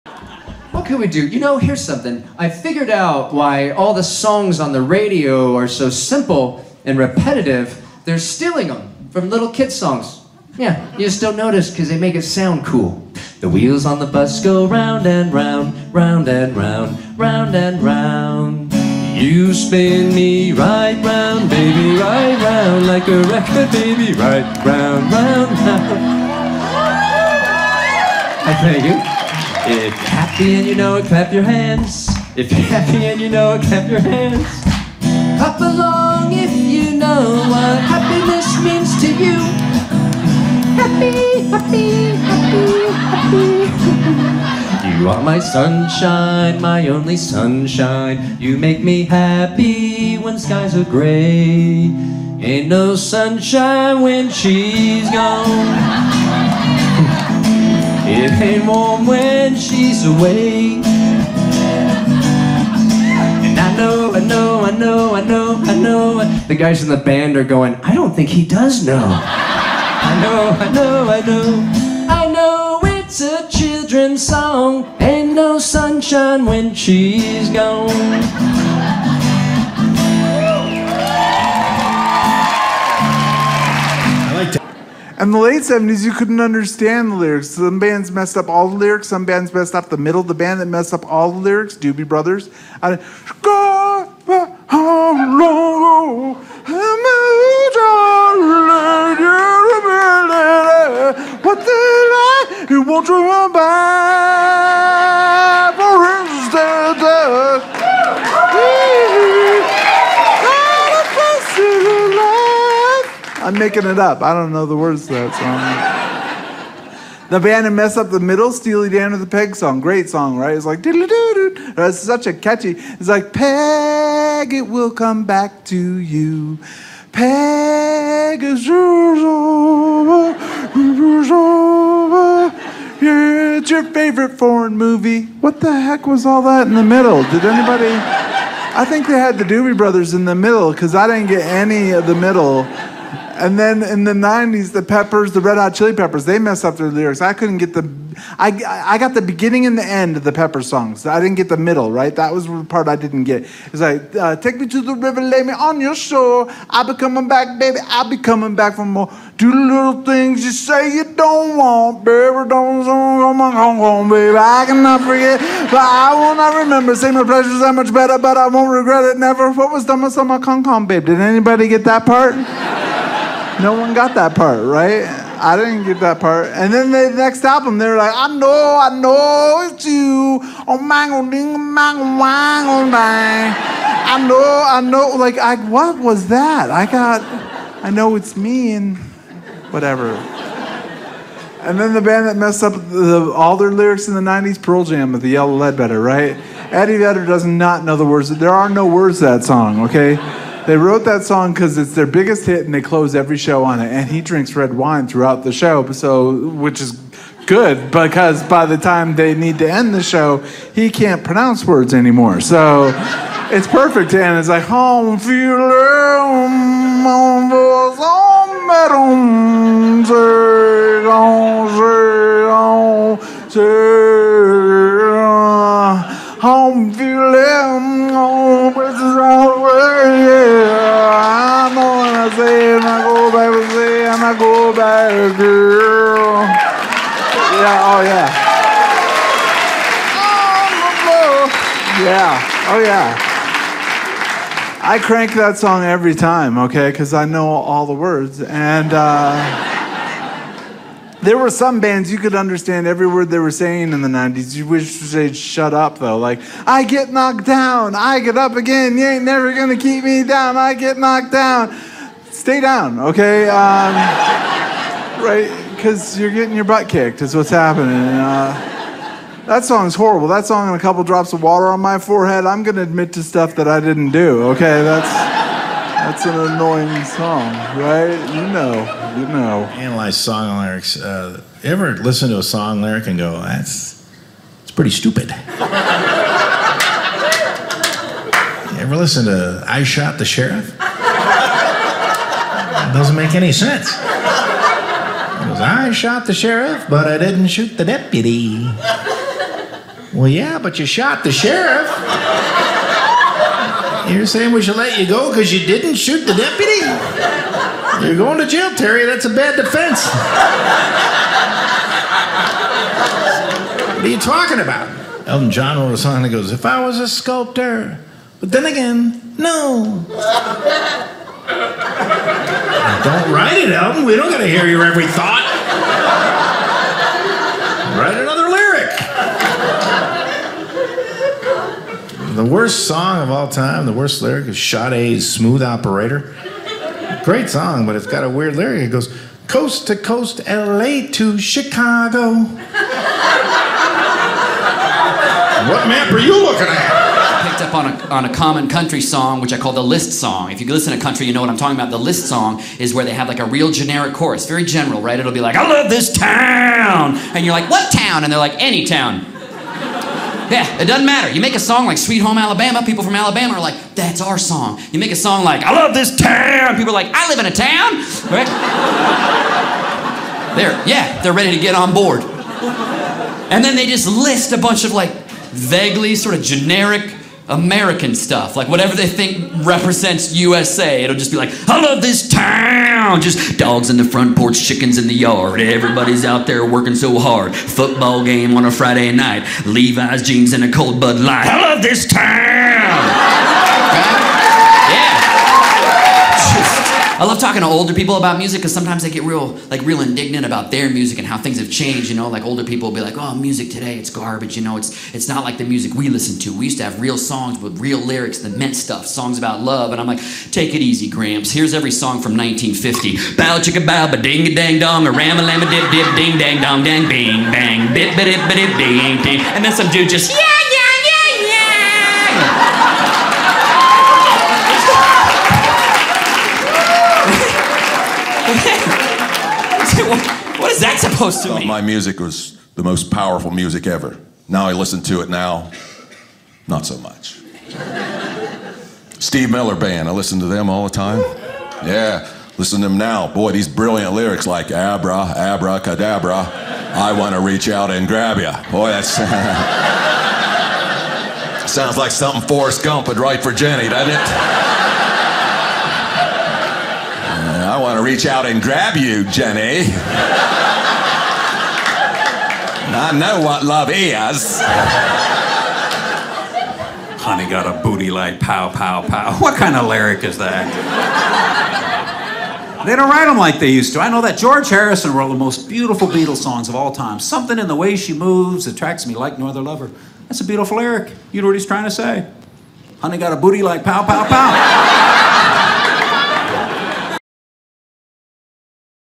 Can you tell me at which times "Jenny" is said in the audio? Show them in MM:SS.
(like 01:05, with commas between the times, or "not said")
07:33, 07:39.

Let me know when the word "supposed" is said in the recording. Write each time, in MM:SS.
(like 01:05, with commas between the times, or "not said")
07:10.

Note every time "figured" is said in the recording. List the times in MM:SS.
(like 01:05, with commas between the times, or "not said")
00:02.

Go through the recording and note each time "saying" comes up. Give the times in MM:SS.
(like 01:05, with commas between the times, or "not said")
04:13, 05:04.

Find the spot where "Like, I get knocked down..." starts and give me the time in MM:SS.
04:16.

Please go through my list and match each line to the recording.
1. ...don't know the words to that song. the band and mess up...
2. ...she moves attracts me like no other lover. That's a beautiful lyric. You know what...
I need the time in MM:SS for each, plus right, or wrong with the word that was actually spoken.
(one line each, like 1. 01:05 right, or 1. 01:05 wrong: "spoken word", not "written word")
1. 01:54 right
2. 07:57 right.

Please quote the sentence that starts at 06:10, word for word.
they're, yeah, they're ready to get on board.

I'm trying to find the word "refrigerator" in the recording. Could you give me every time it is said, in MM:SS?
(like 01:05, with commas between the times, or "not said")
not said.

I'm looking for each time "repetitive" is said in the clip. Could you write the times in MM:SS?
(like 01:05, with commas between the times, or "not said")
00:06.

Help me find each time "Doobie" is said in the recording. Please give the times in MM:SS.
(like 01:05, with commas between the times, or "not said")
01:31, 02:19.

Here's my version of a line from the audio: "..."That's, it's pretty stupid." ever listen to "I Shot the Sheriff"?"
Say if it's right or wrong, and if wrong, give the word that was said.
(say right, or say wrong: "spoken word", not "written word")
right.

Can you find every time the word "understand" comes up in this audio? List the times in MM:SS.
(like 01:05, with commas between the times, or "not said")
01:26, 04:12.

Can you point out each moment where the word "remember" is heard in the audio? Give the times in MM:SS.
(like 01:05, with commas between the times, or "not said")
02:46.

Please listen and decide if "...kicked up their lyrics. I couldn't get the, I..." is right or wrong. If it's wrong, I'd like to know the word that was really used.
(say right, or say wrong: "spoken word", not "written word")
wrong: "messed", not "kicked".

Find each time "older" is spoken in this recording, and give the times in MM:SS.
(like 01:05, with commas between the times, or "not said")
06:37, 06:42.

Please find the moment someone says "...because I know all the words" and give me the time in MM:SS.
04:06.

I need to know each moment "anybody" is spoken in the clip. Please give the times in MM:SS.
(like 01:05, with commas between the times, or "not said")
02:17, 02:51.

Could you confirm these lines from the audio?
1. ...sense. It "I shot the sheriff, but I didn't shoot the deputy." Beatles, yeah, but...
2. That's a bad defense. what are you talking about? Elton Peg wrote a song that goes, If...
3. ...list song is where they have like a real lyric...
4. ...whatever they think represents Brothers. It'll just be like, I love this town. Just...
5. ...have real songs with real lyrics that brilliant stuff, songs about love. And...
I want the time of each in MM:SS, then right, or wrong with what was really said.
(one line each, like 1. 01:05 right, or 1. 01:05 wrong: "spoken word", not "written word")
1. 04:53 wrong: "Well", not "Beatles"
2. 05:09 wrong: "John", not "Peg"
3. 05:51 wrong: "generic", not "lyric"
4. 06:18 wrong: "USA", not "Brothers"
5. 06:46 wrong: "meant", not "brilliant".